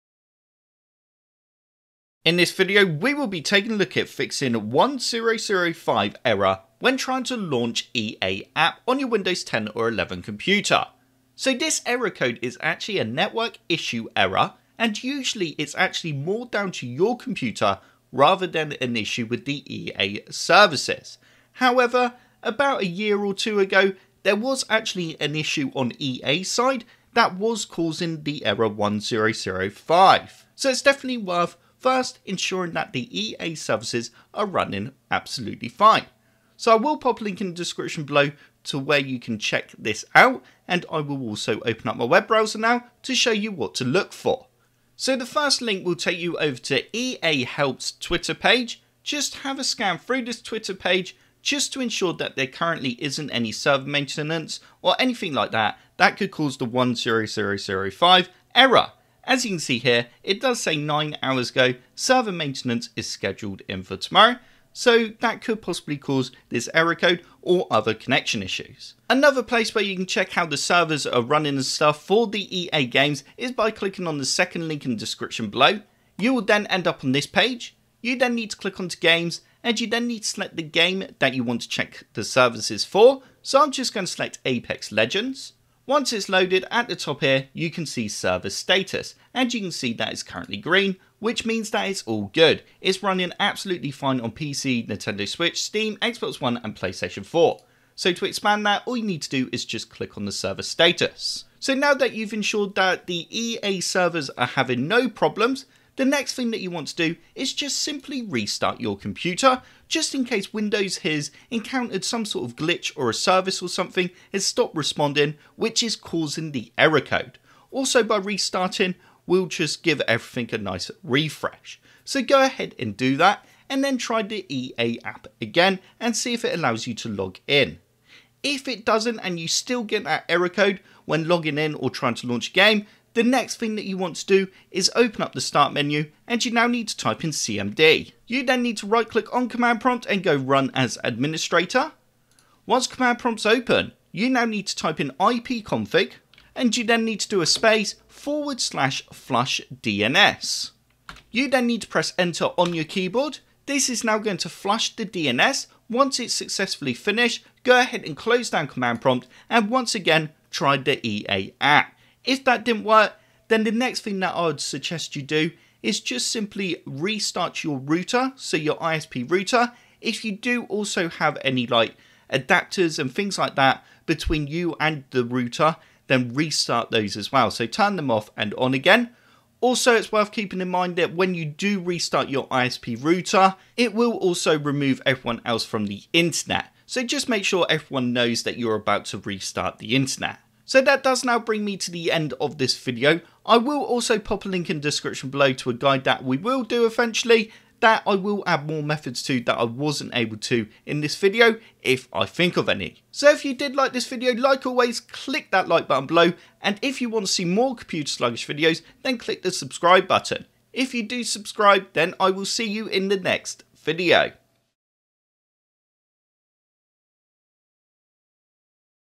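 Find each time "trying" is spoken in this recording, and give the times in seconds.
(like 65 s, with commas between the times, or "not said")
6 s, 131 s.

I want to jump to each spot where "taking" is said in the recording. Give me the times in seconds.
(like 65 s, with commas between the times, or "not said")
3 s.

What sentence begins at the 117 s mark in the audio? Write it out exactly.
Also by restarting, we'll just give everything a nice refresh.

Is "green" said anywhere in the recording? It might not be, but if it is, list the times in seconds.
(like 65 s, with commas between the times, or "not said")
90 s.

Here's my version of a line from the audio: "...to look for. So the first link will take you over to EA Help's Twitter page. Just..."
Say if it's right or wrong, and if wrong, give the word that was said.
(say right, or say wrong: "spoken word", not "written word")
right.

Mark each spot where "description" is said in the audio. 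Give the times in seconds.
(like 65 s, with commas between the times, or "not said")
37 s, 74 s, 194 s.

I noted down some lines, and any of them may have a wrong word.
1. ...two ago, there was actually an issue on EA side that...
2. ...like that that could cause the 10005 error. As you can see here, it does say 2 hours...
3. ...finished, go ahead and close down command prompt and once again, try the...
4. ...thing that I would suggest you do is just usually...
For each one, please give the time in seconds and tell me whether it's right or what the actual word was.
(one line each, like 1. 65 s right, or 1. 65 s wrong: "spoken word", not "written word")
1. 23 s right
2. 55 s wrong: "9", not "2"
3. 156 s right
4. 164 s wrong: "simply", not "usually".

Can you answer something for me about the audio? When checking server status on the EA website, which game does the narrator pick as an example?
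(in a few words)
Apex Legends.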